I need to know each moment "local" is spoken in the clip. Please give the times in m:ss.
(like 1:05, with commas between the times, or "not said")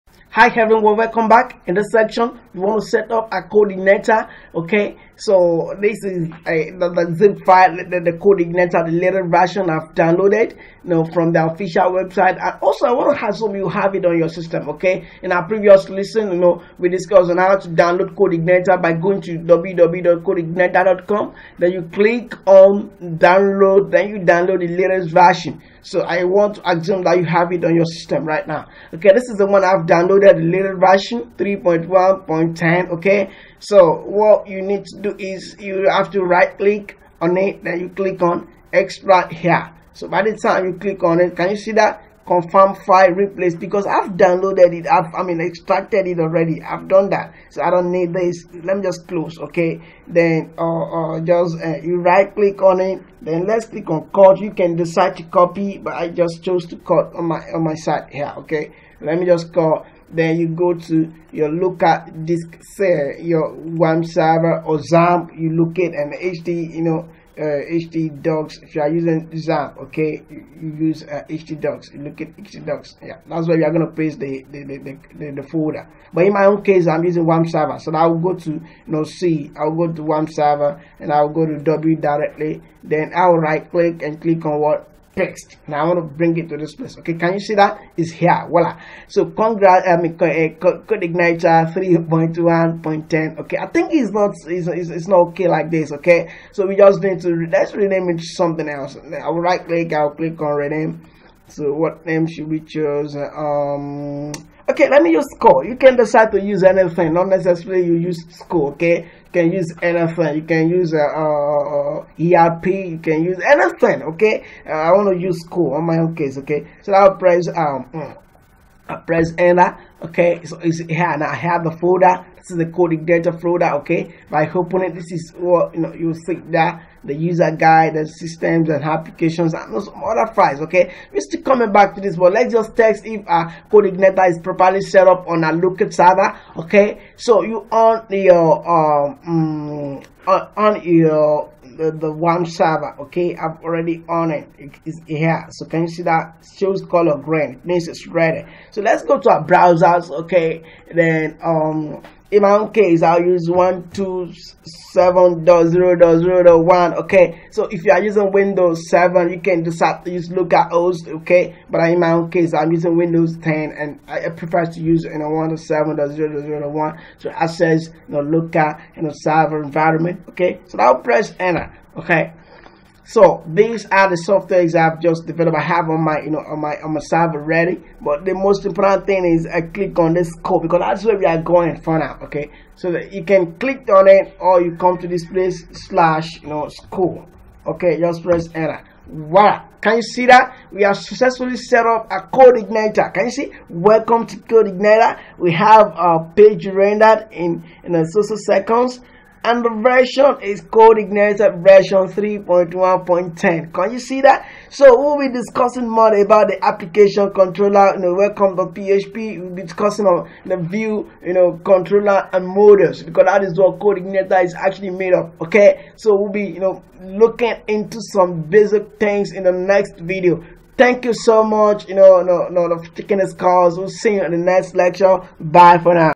1:01, 2:15.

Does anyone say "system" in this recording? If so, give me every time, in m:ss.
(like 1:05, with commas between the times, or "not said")
0:14, 0:27, 2:08.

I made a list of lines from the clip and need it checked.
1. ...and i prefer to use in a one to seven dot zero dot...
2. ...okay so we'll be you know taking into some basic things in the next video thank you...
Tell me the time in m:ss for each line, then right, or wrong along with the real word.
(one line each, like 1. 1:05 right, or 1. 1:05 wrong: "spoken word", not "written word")
1. 2:43 right
2. 3:35 wrong: "looking", not "taking".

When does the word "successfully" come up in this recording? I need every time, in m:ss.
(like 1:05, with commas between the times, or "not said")
3:10.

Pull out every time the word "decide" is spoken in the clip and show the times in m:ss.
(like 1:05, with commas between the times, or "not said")
0:54, 1:45.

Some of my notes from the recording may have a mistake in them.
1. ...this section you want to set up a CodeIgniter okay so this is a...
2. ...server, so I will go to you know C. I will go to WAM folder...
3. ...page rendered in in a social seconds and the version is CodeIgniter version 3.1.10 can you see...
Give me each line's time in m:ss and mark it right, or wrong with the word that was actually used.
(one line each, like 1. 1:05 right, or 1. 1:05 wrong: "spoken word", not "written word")
1. 0:01 right
2. 1:17 wrong: "server", not "folder"
3. 3:16 right.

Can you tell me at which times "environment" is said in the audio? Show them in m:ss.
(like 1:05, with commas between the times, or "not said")
2:49.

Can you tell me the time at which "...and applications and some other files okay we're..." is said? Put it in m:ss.
2:08.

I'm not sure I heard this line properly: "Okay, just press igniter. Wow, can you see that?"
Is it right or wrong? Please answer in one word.
wrong.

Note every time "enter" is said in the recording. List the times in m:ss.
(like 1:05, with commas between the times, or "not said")
1:59, 2:51, 3:08.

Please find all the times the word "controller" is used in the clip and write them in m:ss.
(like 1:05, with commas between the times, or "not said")
3:27, 3:31.